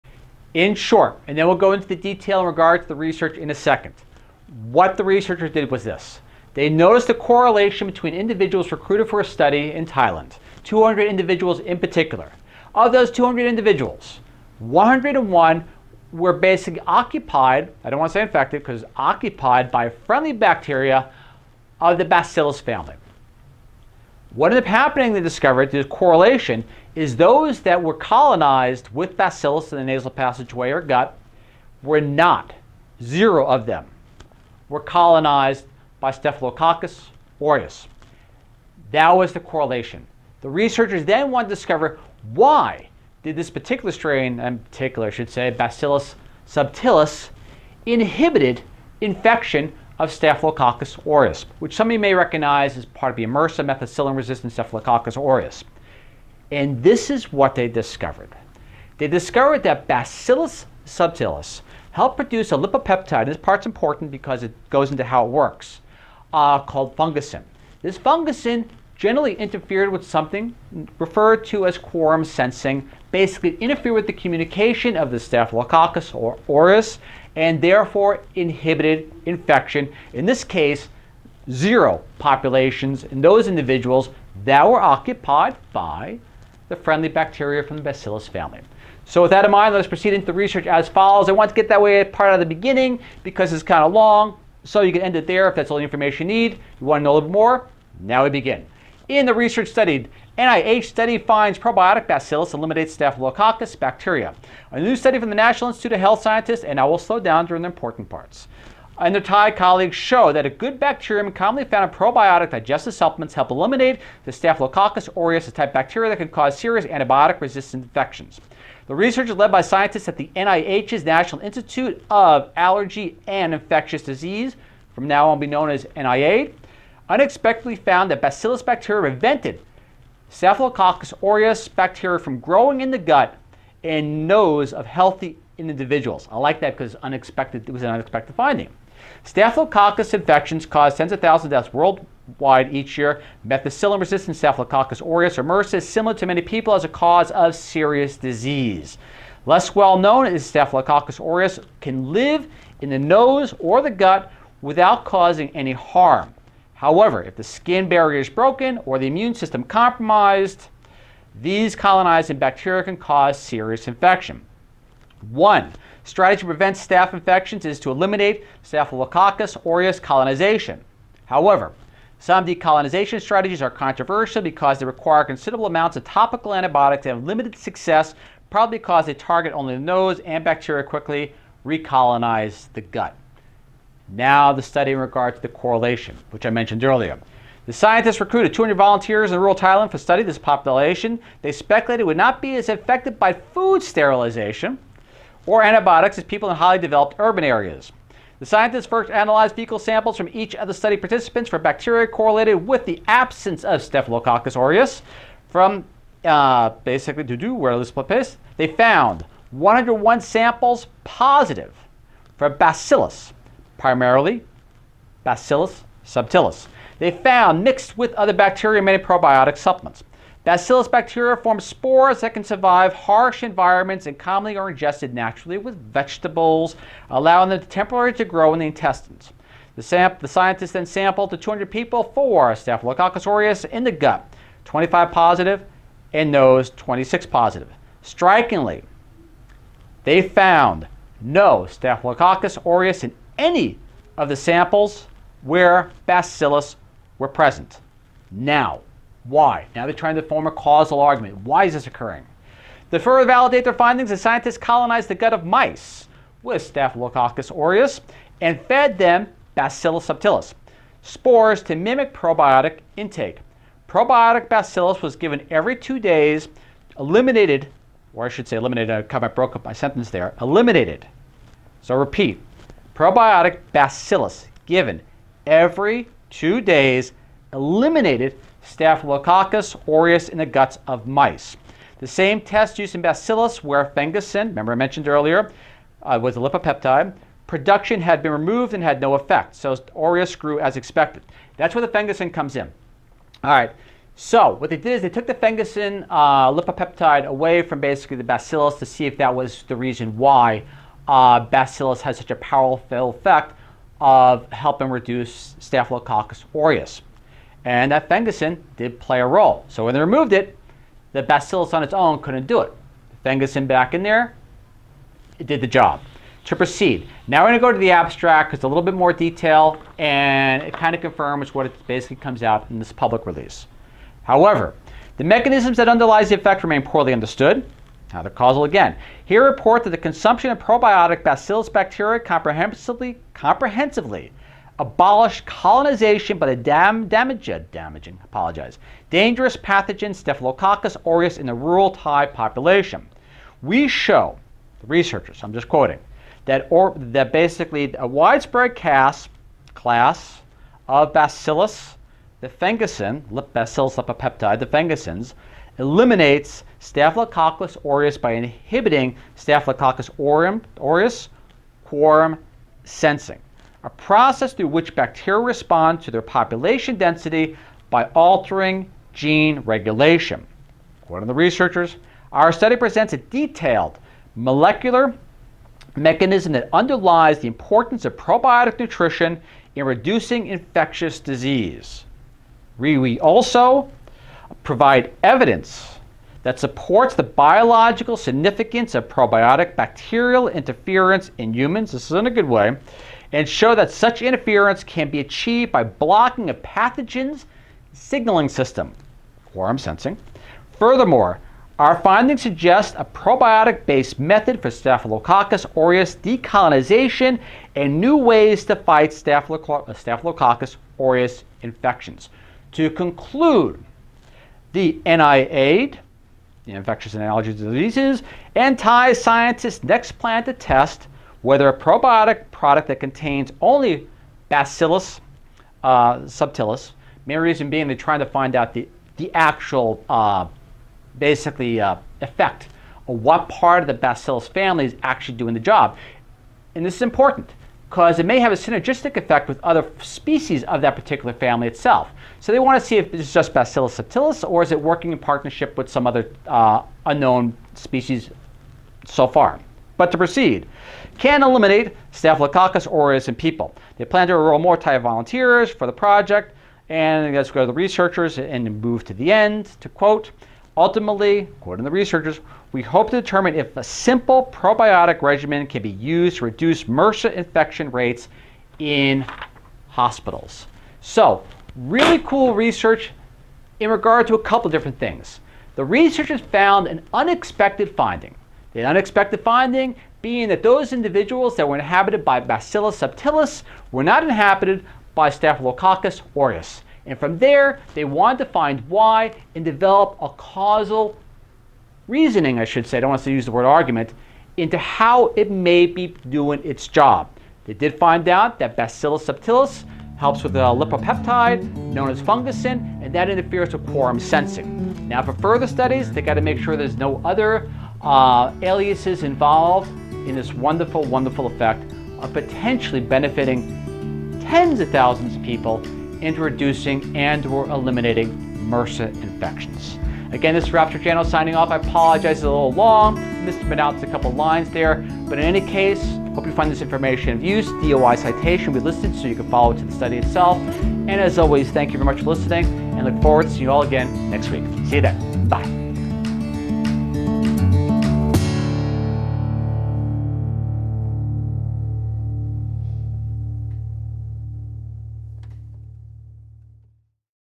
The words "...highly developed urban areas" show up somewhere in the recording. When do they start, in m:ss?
3:16.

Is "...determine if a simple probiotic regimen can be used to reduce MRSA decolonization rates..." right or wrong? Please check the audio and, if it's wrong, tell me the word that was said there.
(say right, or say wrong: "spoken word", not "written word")
wrong: "infection", not "decolonization".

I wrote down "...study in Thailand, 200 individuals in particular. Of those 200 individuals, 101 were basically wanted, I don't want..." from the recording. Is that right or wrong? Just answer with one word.
wrong.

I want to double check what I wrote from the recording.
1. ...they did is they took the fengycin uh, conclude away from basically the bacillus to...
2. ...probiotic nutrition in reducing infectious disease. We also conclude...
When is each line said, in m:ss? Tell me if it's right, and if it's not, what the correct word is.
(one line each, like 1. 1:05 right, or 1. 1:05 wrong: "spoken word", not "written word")
1. 4:54 wrong: "lipopeptide", not "conclude"
2. 6:18 wrong: "provide", not "conclude".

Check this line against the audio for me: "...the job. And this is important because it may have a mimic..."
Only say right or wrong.
wrong.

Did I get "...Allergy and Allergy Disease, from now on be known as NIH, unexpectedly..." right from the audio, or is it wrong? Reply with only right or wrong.
wrong.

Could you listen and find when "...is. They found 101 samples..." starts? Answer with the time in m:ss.
3:28.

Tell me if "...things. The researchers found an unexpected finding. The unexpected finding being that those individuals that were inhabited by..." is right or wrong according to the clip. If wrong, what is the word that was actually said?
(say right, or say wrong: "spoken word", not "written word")
right.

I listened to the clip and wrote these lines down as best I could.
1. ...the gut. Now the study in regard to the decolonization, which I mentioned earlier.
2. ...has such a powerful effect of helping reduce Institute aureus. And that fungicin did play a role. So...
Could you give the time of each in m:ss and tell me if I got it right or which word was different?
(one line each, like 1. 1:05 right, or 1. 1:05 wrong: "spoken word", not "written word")
1. 3:02 wrong: "correlation", not "decolonization"
2. 5:02 wrong: "Staphylococcus", not "Institute".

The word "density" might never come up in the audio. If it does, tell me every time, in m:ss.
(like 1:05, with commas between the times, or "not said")
6:06.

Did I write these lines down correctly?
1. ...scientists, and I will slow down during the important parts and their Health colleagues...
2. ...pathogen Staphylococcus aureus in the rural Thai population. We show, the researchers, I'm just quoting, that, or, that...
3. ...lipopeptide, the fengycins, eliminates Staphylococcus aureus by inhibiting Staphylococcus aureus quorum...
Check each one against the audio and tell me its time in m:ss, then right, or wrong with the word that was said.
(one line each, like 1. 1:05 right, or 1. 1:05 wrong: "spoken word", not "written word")
1. 1:46 wrong: "Thai", not "Health"
2. 5:39 right
3. 5:53 right.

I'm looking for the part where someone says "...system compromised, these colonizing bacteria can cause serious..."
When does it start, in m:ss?
2:39.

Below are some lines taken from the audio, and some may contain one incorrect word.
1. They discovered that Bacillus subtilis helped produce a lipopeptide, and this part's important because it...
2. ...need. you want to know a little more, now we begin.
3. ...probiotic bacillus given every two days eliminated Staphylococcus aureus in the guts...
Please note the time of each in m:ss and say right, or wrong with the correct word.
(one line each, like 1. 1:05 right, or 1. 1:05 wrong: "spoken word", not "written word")
1. 0:58 right
2. 1:36 right
3. 4:33 right.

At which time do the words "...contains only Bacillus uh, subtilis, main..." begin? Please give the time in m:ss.
7:02.